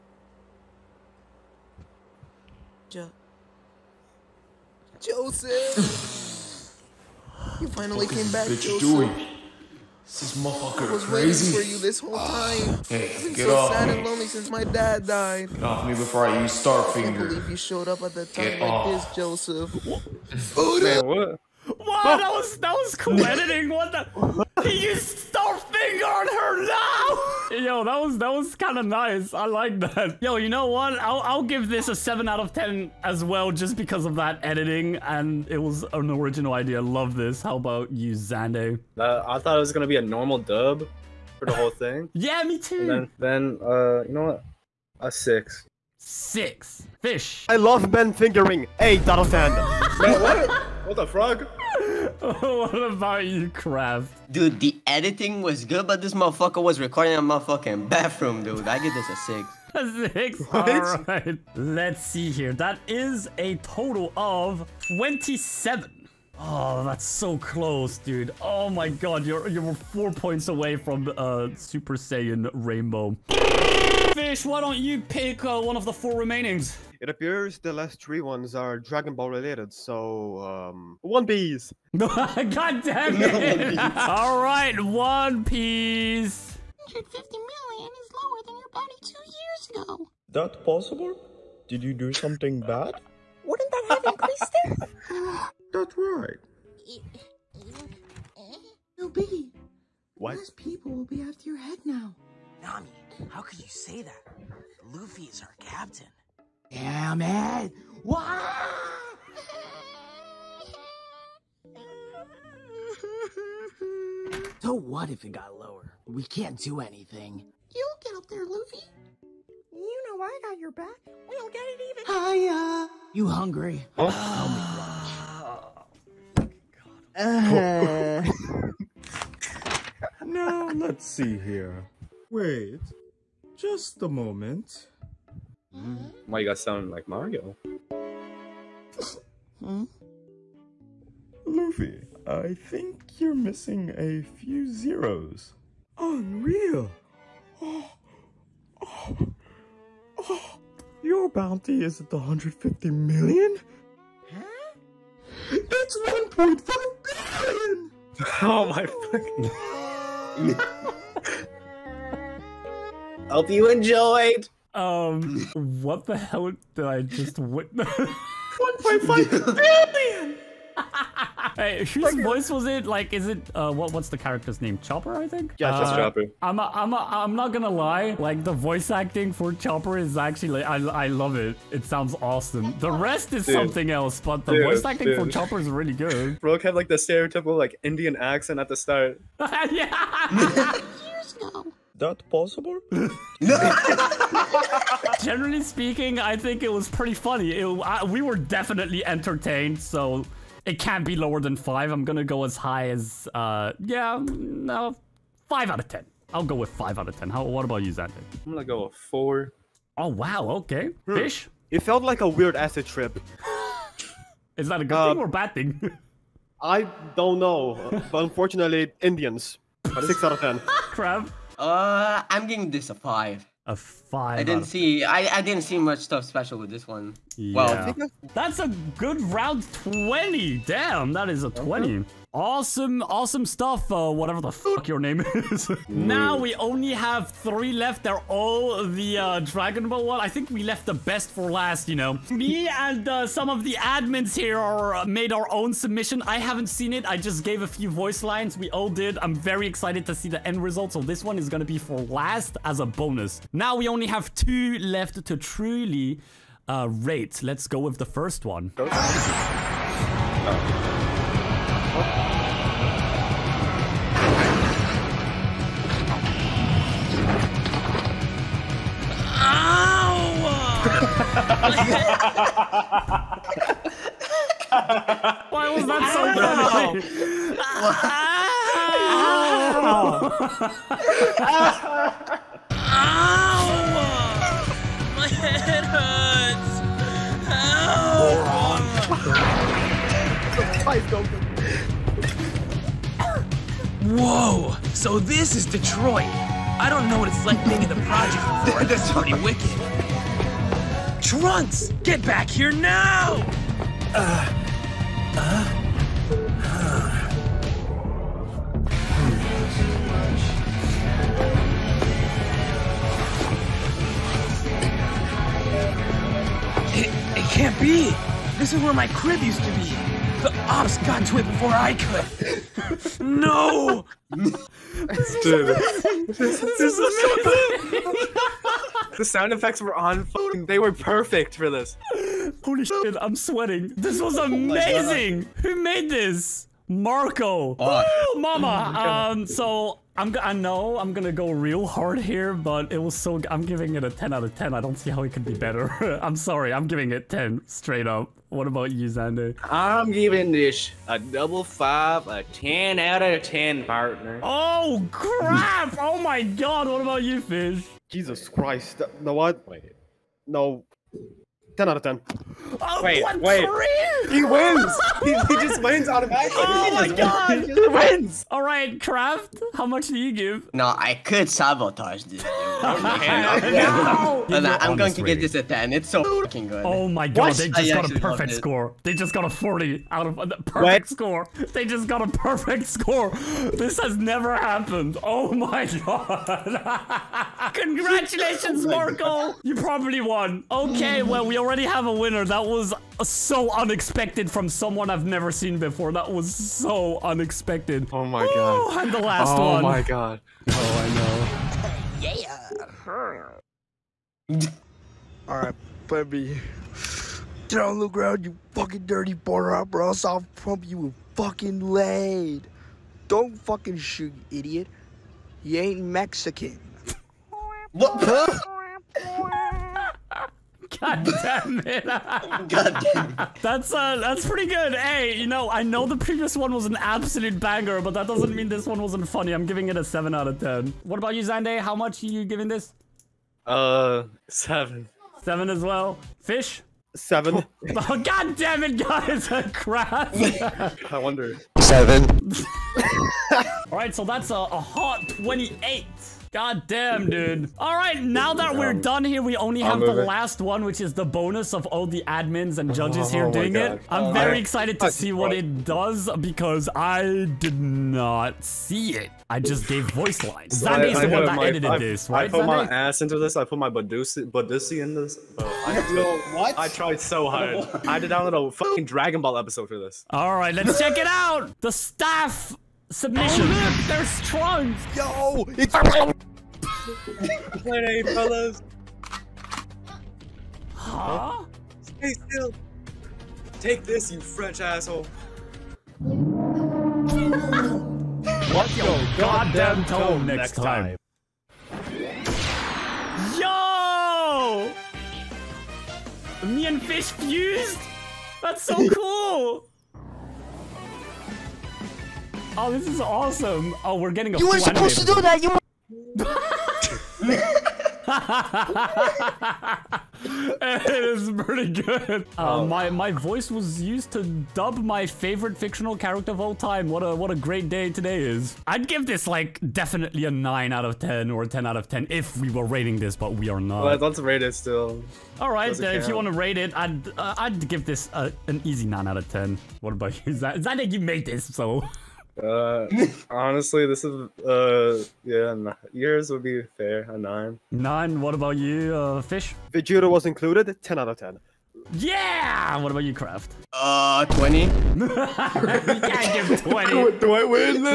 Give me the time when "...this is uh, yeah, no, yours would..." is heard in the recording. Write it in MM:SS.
08:54.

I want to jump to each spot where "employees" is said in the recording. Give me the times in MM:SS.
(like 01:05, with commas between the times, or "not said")
not said.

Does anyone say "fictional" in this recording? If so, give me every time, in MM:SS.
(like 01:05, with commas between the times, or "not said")
08:35.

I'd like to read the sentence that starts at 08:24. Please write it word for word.
Oh, we're getting a You weren't supposed to do that.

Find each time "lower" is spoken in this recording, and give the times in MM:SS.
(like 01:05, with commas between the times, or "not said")
01:28, 01:55, 03:21.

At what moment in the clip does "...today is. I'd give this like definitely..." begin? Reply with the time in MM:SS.
08:38.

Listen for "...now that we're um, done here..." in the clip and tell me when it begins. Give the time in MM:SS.
07:28.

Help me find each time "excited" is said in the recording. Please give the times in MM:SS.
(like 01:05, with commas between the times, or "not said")
04:09, 07:34.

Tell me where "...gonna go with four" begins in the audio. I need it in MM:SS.
03:28.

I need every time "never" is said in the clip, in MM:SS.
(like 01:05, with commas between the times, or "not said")
06:24, 06:35.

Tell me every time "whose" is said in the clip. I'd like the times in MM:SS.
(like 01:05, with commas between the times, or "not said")
02:51.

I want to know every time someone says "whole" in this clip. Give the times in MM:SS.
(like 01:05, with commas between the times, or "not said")
00:12, 00:41.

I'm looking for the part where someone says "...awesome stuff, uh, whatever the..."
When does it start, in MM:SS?
03:53.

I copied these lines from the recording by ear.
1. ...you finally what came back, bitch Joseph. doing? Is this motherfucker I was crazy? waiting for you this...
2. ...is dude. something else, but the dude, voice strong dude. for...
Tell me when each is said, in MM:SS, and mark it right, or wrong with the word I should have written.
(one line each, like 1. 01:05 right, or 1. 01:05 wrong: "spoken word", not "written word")
1. 00:07 right
2. 03:03 wrong: "acting", not "strong".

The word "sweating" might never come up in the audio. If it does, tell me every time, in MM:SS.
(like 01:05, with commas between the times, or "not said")
05:33.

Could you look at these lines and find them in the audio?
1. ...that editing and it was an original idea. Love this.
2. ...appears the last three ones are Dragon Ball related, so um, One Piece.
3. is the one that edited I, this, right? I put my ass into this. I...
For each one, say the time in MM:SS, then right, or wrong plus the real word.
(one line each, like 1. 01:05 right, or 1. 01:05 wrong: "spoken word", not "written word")
1. 00:34 right
2. 01:17 right
3. 07:40 right.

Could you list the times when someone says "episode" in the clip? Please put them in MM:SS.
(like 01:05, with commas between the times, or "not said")
07:49.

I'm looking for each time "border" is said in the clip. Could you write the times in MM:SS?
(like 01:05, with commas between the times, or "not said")
06:49.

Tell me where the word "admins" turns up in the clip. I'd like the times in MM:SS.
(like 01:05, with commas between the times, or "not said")
04:03, 07:32.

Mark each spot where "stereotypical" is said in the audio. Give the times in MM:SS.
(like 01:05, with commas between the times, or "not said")
03:06.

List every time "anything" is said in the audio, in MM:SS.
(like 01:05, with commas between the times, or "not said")
01:56.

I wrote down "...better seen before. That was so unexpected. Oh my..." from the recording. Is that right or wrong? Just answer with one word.
wrong.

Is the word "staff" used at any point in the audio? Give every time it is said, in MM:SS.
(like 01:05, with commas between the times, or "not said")
07:51.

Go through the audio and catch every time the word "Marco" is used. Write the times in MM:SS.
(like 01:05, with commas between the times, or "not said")
05:36, 06:28.